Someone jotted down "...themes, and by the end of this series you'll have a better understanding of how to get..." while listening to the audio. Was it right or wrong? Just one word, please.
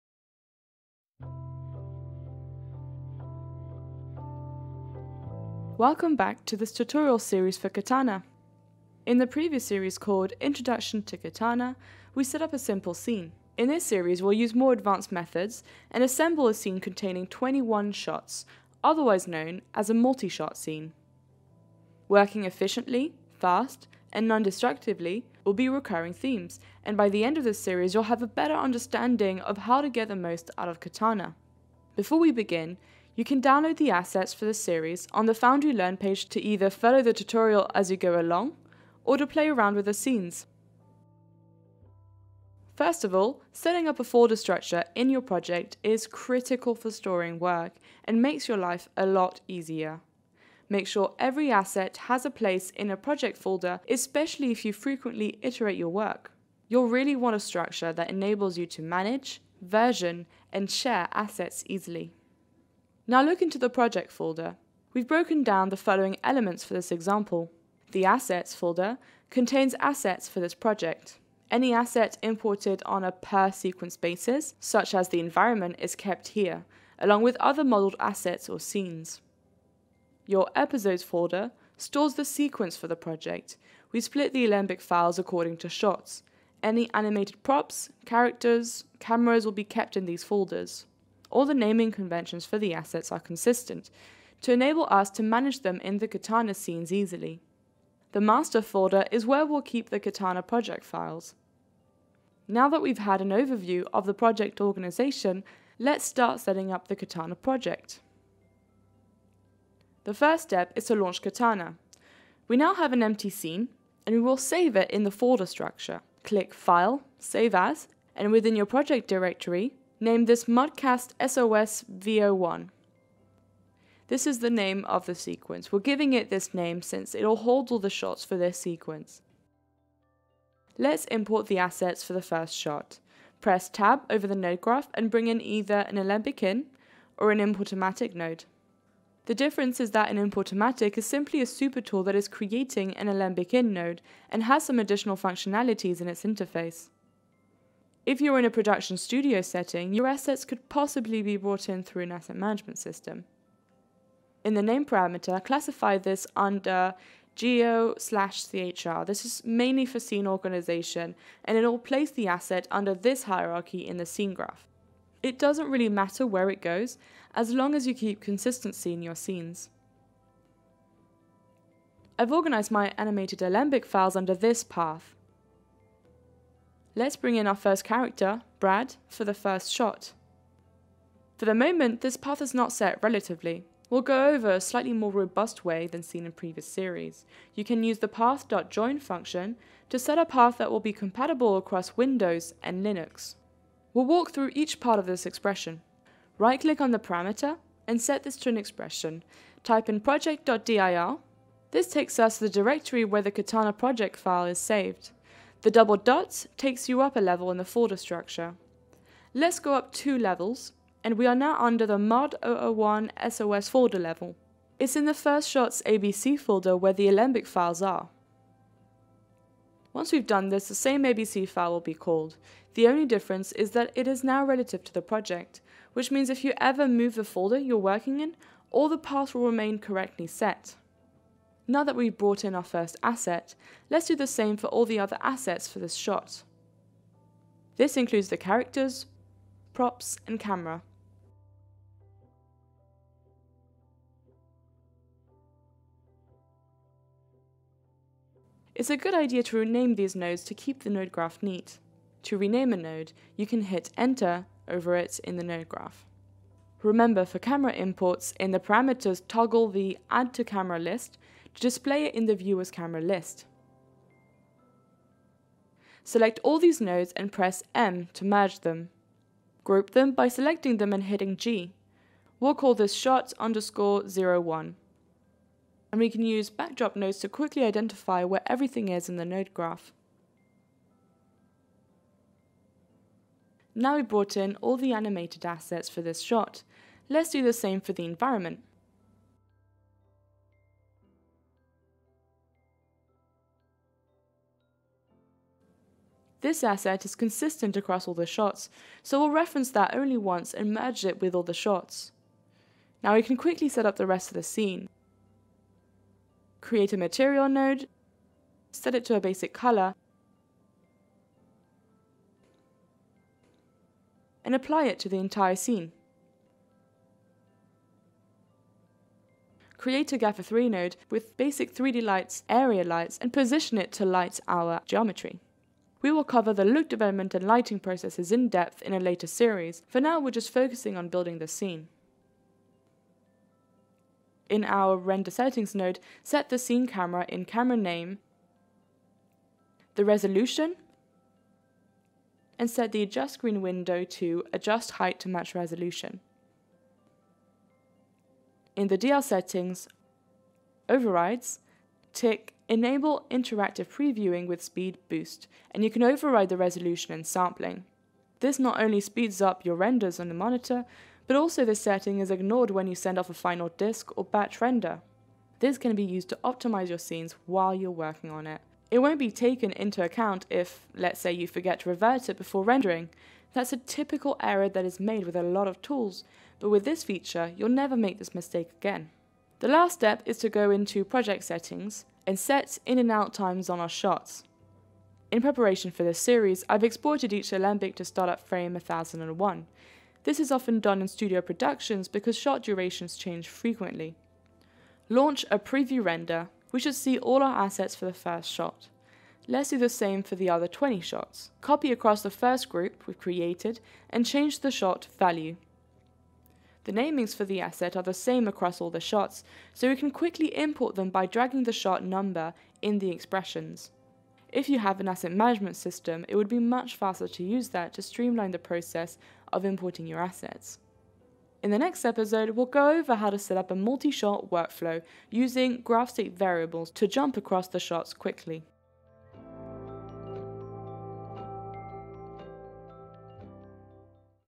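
right.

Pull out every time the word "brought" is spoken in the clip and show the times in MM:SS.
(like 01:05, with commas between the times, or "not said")
02:31, 03:52, 04:44.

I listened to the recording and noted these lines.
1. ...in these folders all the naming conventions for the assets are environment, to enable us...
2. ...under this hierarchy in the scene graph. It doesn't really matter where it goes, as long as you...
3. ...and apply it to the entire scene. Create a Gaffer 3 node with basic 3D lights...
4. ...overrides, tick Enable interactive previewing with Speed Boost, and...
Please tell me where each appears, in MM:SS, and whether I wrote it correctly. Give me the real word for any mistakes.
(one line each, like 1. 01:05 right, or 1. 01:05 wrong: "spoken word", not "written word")
1. 01:29 wrong: "consistent", not "environment"
2. 02:42 right
3. 05:14 right
4. 05:50 right.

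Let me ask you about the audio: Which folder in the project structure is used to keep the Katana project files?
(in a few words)
master folder.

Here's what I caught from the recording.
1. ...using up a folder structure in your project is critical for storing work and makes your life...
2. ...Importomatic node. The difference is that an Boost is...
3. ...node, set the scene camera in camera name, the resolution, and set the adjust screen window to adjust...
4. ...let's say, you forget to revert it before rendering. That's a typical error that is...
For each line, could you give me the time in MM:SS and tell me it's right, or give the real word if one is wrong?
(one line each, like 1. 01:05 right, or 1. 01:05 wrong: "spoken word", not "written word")
1. 00:43 wrong: "setting", not "using"
2. 02:17 wrong: "Importomatic", not "Boost"
3. 05:35 right
4. 06:10 right.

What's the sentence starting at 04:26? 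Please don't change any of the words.
Select all these nodes and press M to merge them.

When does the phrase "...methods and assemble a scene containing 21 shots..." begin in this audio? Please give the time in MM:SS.
00:15.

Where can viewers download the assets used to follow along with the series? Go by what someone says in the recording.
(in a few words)
Foundry Learn.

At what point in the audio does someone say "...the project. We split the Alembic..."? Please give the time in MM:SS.
01:22.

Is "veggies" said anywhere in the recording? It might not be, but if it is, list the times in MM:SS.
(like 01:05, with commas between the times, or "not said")
not said.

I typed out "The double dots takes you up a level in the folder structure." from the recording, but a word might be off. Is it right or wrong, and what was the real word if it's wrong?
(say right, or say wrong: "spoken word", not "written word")
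right.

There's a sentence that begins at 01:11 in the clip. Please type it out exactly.
Any asset imported on a per sequence basis, such as the environment, is kept here, along with other modeled assets or scenes.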